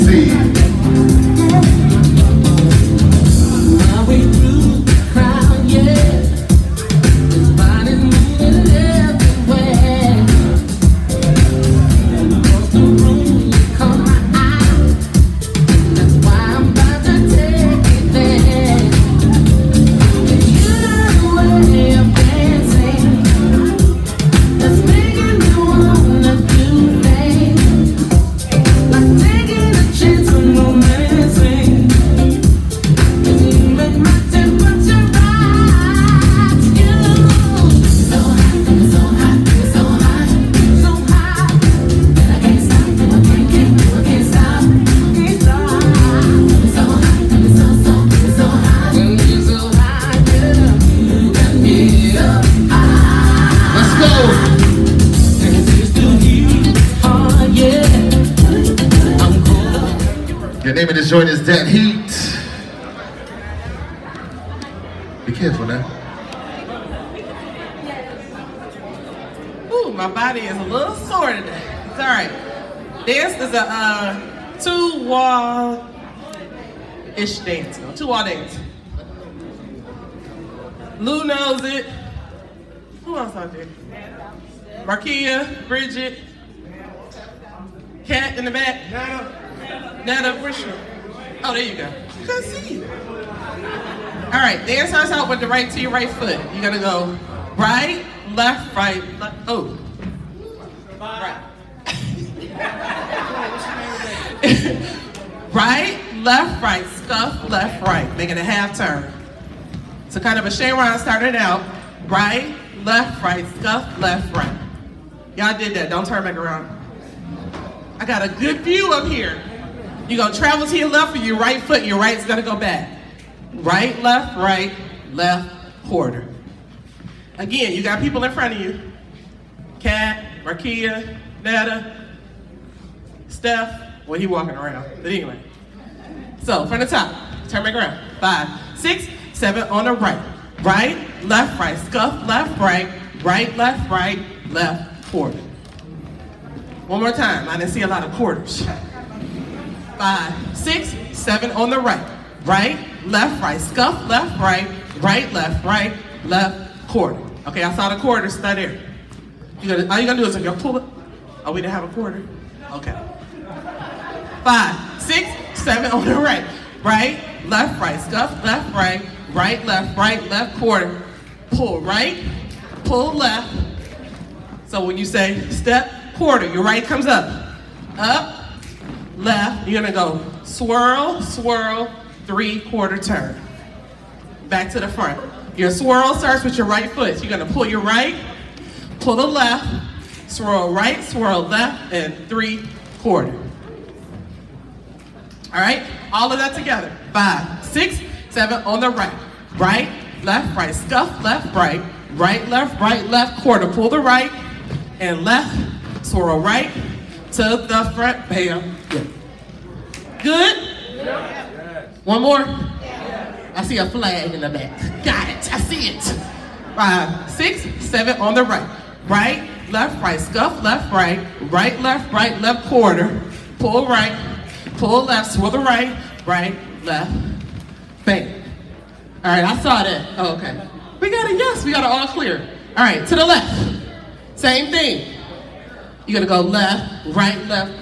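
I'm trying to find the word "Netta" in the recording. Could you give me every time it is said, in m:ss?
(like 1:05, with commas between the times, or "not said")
2:11.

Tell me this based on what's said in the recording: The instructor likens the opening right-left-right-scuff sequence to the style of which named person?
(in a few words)
Shane Ryan.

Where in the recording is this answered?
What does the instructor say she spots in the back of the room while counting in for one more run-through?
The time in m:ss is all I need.
3:33.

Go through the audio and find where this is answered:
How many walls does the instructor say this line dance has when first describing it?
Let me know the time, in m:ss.
1:17.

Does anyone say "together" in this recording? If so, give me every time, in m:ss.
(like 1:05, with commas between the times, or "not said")
3:16.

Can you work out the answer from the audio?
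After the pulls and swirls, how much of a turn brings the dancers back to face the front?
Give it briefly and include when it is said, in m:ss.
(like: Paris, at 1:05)
Three quarter turn, at 3:02.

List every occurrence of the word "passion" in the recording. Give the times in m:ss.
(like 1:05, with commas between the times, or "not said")
not said.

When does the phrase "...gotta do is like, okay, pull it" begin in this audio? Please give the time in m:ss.
2:40.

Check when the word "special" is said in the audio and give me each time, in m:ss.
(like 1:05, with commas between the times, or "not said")
not said.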